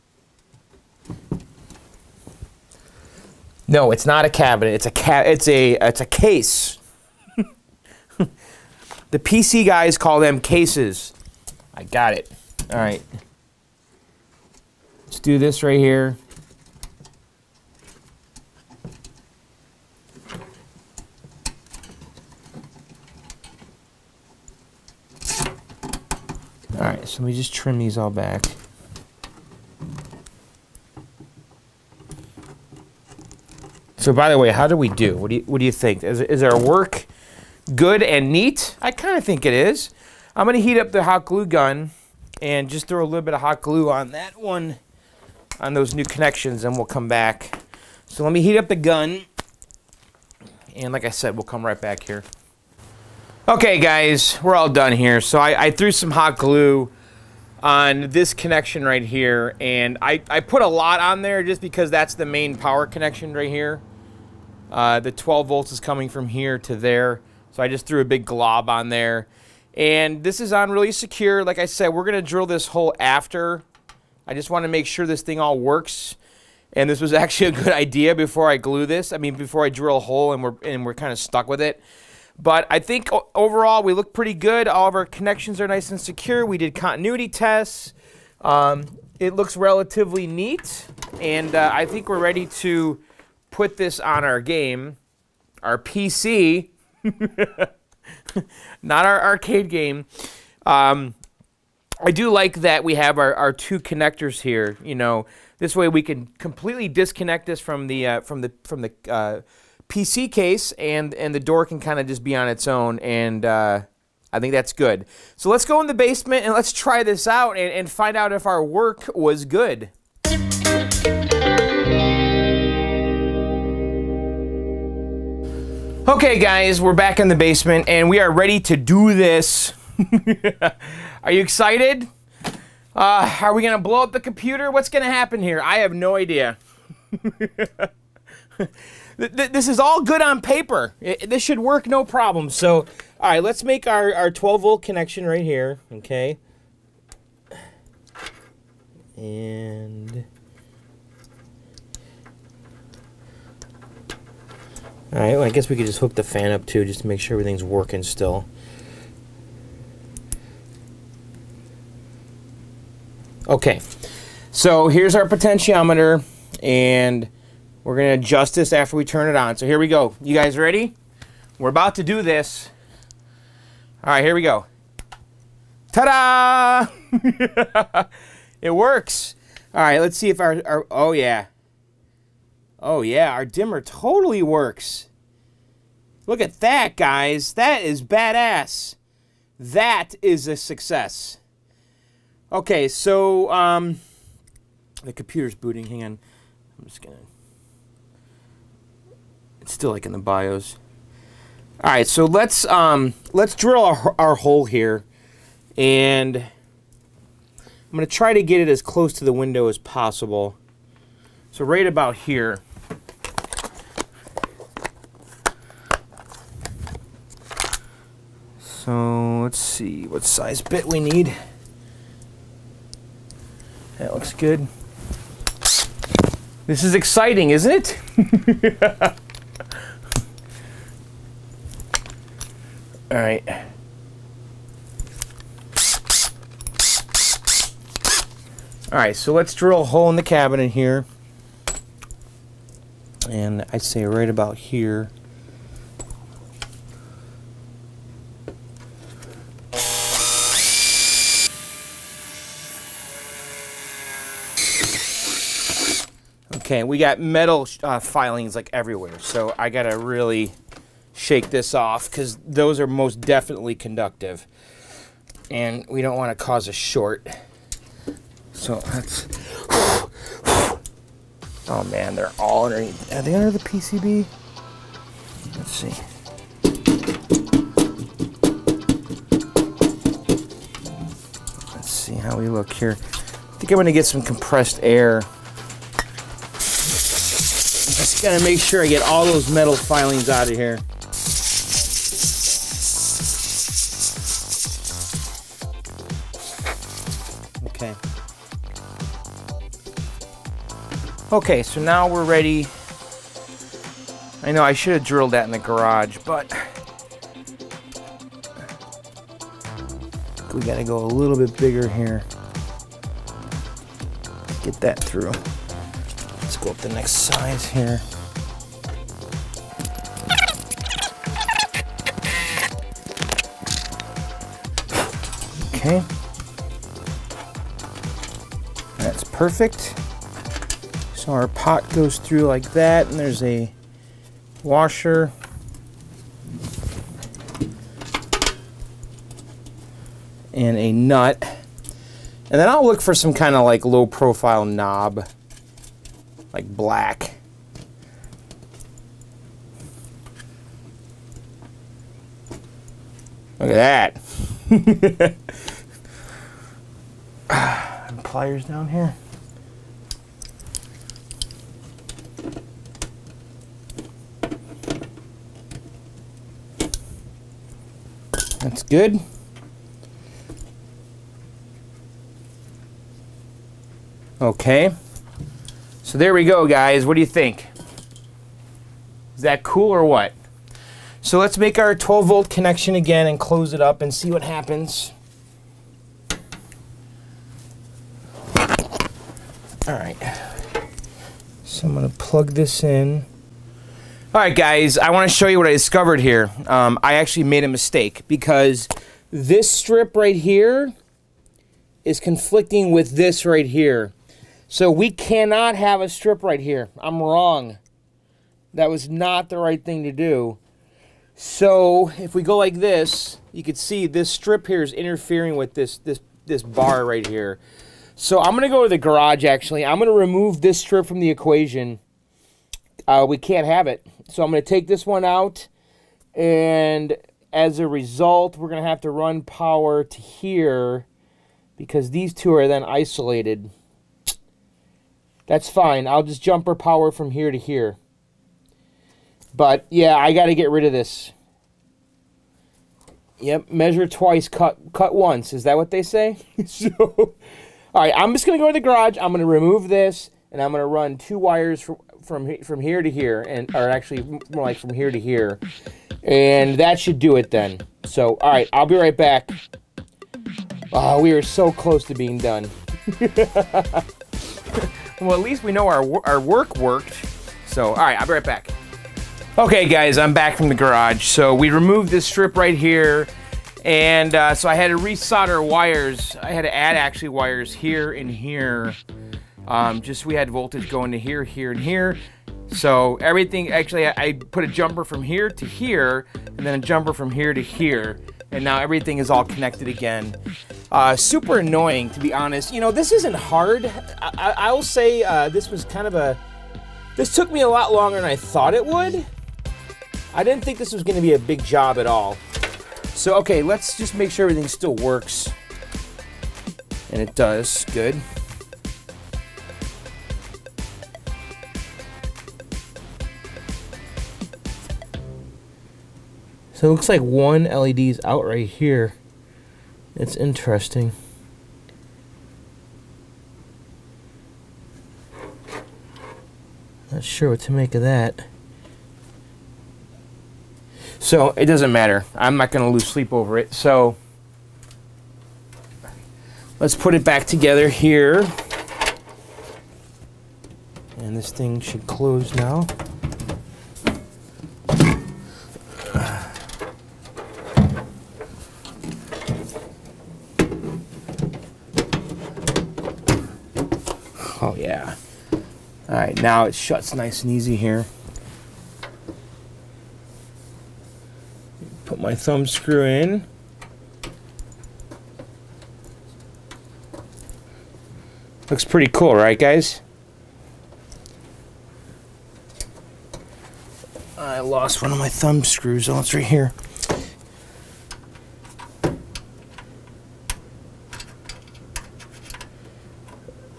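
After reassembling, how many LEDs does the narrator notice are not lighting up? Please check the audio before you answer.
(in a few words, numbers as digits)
1.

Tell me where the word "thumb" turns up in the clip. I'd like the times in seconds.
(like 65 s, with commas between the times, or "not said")
562 s, 575 s.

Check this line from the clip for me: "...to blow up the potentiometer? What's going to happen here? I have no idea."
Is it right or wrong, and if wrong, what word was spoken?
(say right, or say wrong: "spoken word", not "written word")
wrong: "computer", not "potentiometer".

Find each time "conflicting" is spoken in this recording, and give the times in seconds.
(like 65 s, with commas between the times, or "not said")
402 s.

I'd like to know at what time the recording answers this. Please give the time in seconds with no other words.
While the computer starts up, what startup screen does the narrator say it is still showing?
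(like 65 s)
200 s.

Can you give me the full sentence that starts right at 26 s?
Alright, so let me just trim these all back.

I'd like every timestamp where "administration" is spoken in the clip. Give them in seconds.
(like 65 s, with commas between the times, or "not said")
not said.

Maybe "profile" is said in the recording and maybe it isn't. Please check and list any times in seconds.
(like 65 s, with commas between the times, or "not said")
344 s.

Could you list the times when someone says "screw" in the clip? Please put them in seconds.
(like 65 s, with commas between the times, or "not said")
562 s, 575 s.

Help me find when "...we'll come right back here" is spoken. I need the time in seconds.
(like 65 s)
51 s.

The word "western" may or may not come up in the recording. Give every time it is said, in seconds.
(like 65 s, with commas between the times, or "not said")
not said.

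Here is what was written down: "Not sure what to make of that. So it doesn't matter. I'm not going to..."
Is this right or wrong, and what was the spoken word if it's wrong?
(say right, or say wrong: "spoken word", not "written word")
right.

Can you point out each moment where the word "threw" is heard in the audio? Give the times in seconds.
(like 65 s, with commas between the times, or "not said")
55 s, 67 s.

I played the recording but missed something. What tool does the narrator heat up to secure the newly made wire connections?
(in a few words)
hot glue gun.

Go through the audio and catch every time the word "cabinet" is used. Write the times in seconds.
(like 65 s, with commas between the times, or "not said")
4 s, 240 s.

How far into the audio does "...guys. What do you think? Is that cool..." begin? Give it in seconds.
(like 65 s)
376 s.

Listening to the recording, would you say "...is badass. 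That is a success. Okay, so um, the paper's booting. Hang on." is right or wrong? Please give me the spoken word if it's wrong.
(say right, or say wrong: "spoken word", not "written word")
wrong: "computer", not "paper".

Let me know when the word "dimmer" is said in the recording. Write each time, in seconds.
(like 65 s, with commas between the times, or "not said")
183 s.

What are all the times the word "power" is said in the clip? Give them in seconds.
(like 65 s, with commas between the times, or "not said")
62 s, 429 s, 436 s.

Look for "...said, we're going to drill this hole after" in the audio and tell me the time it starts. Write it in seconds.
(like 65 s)
71 s.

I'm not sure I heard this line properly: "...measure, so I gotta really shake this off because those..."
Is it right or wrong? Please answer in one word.
wrong.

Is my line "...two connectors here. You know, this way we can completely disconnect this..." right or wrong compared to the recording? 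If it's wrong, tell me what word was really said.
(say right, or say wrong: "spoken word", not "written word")
right.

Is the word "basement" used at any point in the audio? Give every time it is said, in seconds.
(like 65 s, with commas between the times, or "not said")
115 s, 127 s.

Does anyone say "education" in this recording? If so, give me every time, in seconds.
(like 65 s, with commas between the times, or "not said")
not said.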